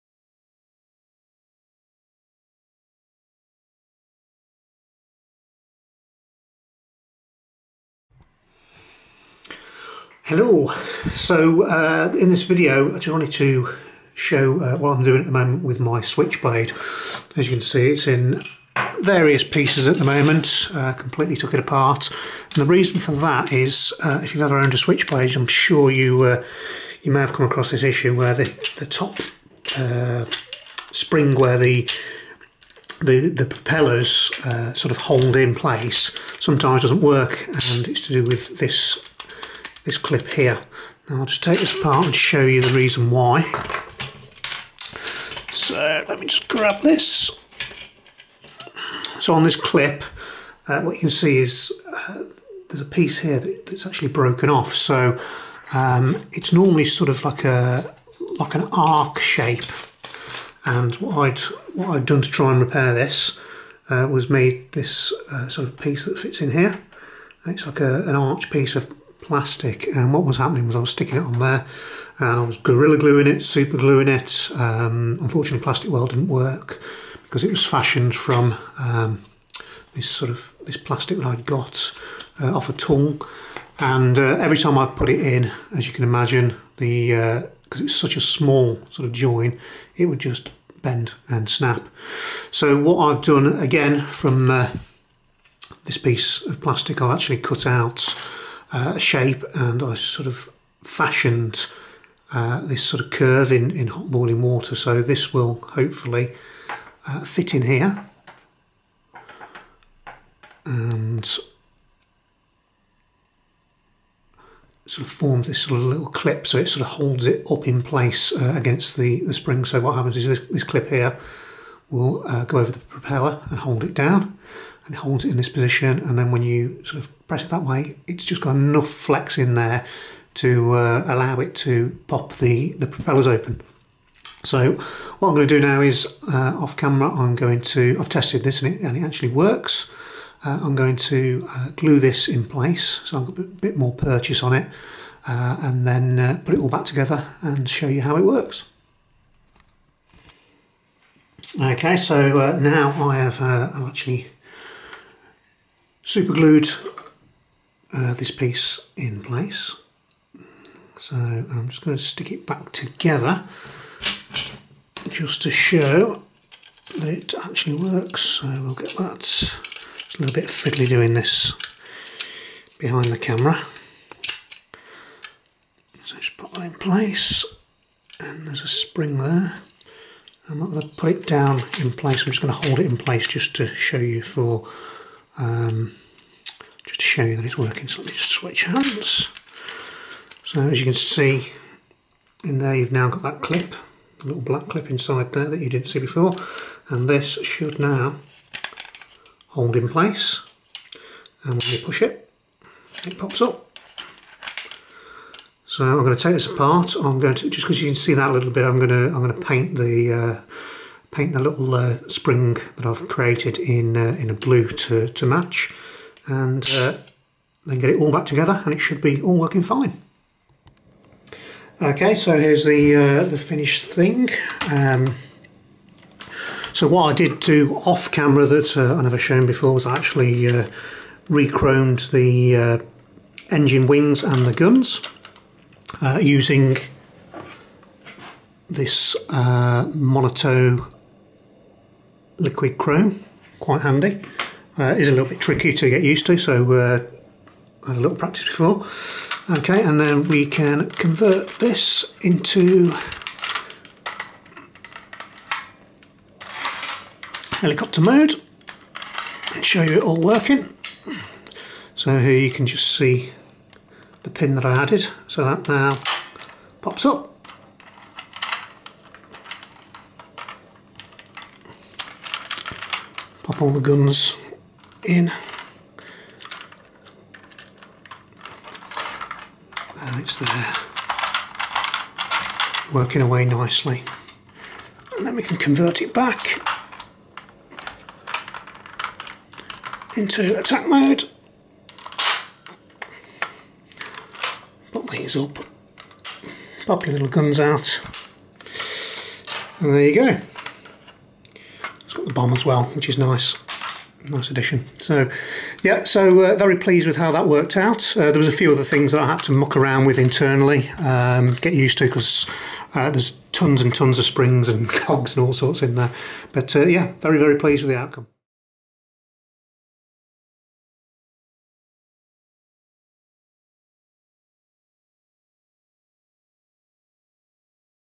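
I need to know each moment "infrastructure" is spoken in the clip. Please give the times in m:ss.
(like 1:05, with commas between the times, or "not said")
not said.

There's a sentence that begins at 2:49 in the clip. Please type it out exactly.
It's a little bit fiddly doing this behind the camera.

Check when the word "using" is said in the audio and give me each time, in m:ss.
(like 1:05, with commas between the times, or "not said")
3:56.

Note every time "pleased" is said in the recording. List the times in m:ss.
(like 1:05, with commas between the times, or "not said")
5:06, 5:17.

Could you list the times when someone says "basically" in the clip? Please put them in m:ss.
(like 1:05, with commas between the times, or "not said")
not said.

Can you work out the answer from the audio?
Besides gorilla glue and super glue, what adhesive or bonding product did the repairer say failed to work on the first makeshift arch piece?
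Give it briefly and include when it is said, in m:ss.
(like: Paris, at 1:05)
Plastic weld, at 1:15.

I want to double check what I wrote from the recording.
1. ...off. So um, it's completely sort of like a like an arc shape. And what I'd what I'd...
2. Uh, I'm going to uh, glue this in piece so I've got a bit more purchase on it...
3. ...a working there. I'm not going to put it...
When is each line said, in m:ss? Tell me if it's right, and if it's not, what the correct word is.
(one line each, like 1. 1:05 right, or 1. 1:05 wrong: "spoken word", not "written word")
1. 0:54 wrong: "normally", not "completely"
2. 2:20 wrong: "place", not "piece"
3. 2:58 wrong: "spring", not "working".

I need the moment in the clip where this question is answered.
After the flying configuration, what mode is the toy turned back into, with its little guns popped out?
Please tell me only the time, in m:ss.
4:50.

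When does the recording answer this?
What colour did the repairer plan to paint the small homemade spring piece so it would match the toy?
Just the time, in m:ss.
3:34.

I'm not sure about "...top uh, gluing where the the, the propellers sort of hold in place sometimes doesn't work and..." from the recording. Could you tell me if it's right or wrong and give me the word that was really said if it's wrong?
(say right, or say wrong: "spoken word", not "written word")
wrong: "spring", not "gluing".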